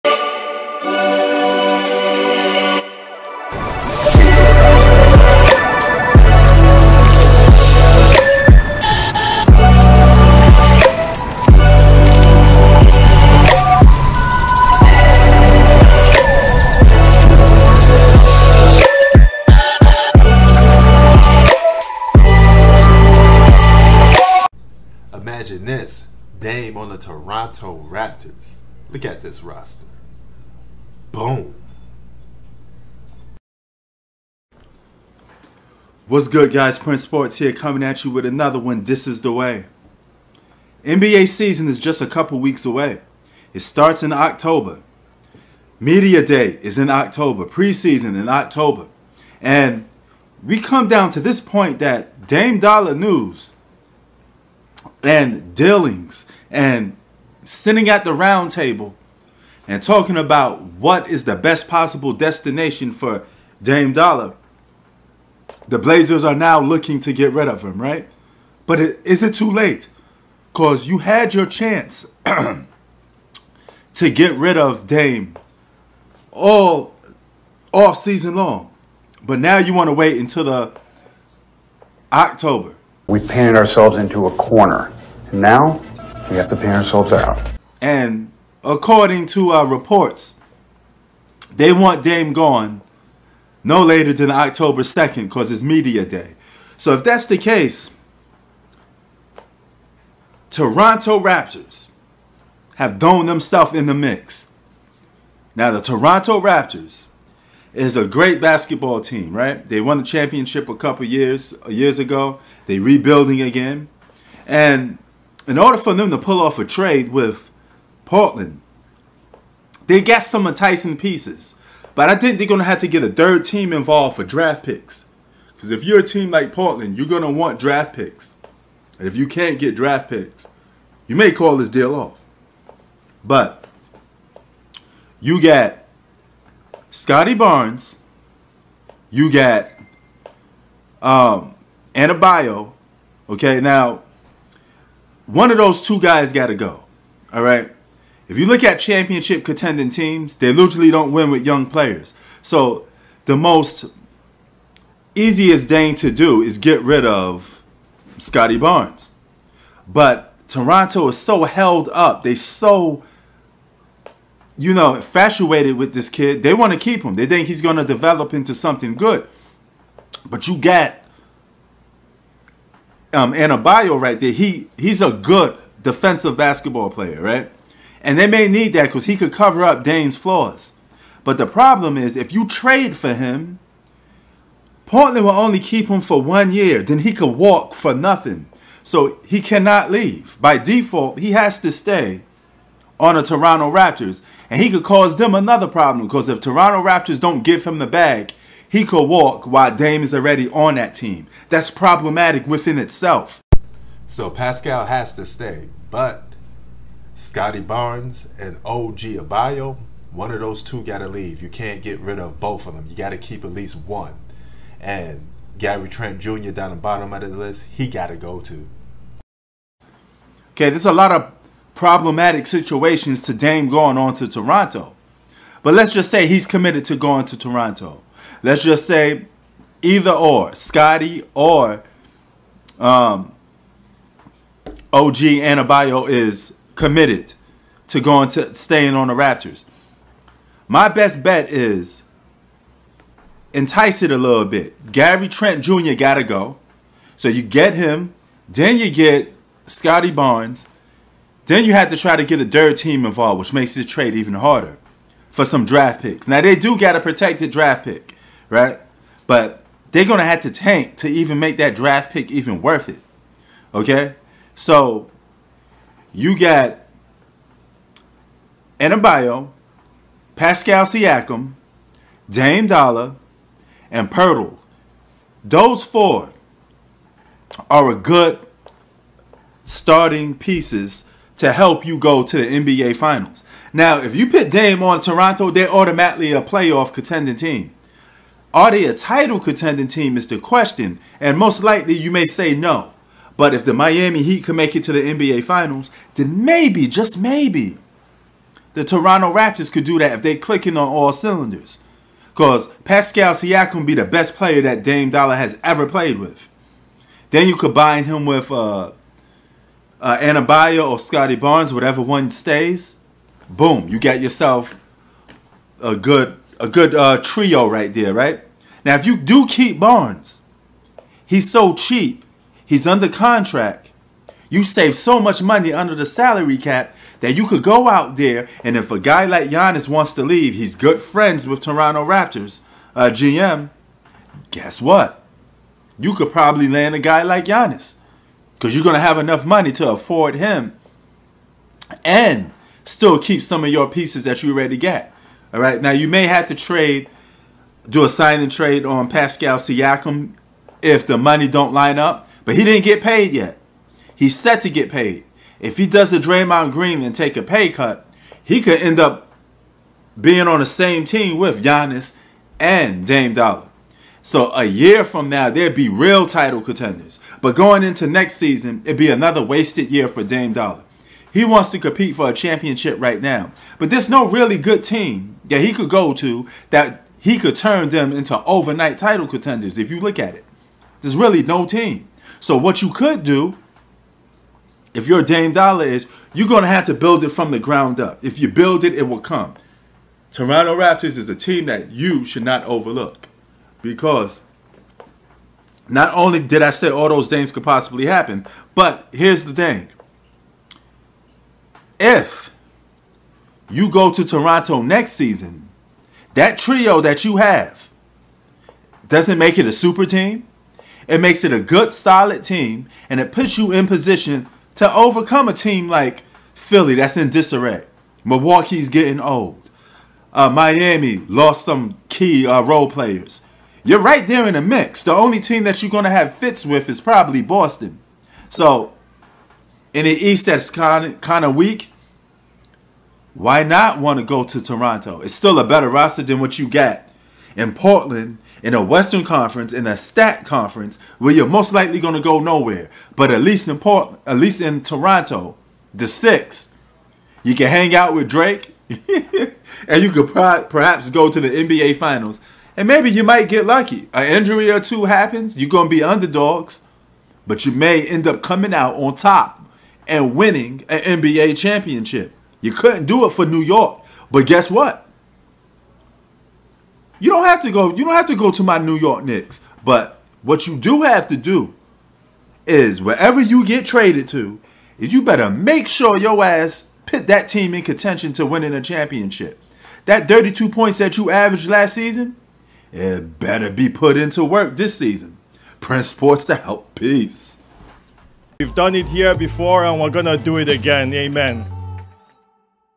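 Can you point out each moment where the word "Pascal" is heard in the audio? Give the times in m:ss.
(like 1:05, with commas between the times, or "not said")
3:24, 4:30, 5:02, 5:49.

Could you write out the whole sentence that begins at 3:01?
But the problem is, if you trade for him, Portland will only keep him for one year.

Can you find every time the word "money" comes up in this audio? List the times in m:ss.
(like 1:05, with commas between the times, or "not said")
5:25, 5:39, 5:51.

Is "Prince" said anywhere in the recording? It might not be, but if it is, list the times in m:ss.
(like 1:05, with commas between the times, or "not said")
0:36, 8:05.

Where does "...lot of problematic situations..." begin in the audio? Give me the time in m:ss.
3:40.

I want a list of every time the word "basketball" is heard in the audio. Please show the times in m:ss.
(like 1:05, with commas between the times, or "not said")
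1:48, 2:56.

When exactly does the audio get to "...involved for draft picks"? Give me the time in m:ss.
2:03.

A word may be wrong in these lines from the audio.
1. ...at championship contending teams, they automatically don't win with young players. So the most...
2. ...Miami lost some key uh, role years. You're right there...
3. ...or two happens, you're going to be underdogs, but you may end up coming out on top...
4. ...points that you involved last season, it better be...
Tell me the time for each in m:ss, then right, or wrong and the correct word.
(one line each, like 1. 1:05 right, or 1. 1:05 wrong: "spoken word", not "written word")
1. 2:28 wrong: "literally", not "automatically"
2. 7:00 wrong: "players", not "years"
3. 7:34 right
4. 8:00 wrong: "averaged", not "involved".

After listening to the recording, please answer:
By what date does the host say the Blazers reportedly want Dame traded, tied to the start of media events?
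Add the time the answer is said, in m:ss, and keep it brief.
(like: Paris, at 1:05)
October 2nd, at 1:34.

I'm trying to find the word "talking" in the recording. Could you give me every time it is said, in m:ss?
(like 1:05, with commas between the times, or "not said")
0:59.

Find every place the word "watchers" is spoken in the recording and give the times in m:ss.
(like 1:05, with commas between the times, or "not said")
not said.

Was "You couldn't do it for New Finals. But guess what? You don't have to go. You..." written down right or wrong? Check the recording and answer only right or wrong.
wrong.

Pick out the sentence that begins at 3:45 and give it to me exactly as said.
But let's just say he's committed to going to Toronto.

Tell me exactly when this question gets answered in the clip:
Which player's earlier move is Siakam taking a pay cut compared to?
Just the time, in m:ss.
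5:56.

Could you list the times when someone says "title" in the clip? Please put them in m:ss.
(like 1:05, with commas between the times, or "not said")
4:48, 6:06, 6:18.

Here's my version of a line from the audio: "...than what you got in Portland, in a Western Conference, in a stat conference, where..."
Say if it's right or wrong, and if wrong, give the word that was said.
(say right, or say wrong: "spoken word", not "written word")
right.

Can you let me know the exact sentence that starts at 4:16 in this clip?
Now they do got a protected draft pick right?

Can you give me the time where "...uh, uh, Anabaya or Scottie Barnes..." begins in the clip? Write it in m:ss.
5:08.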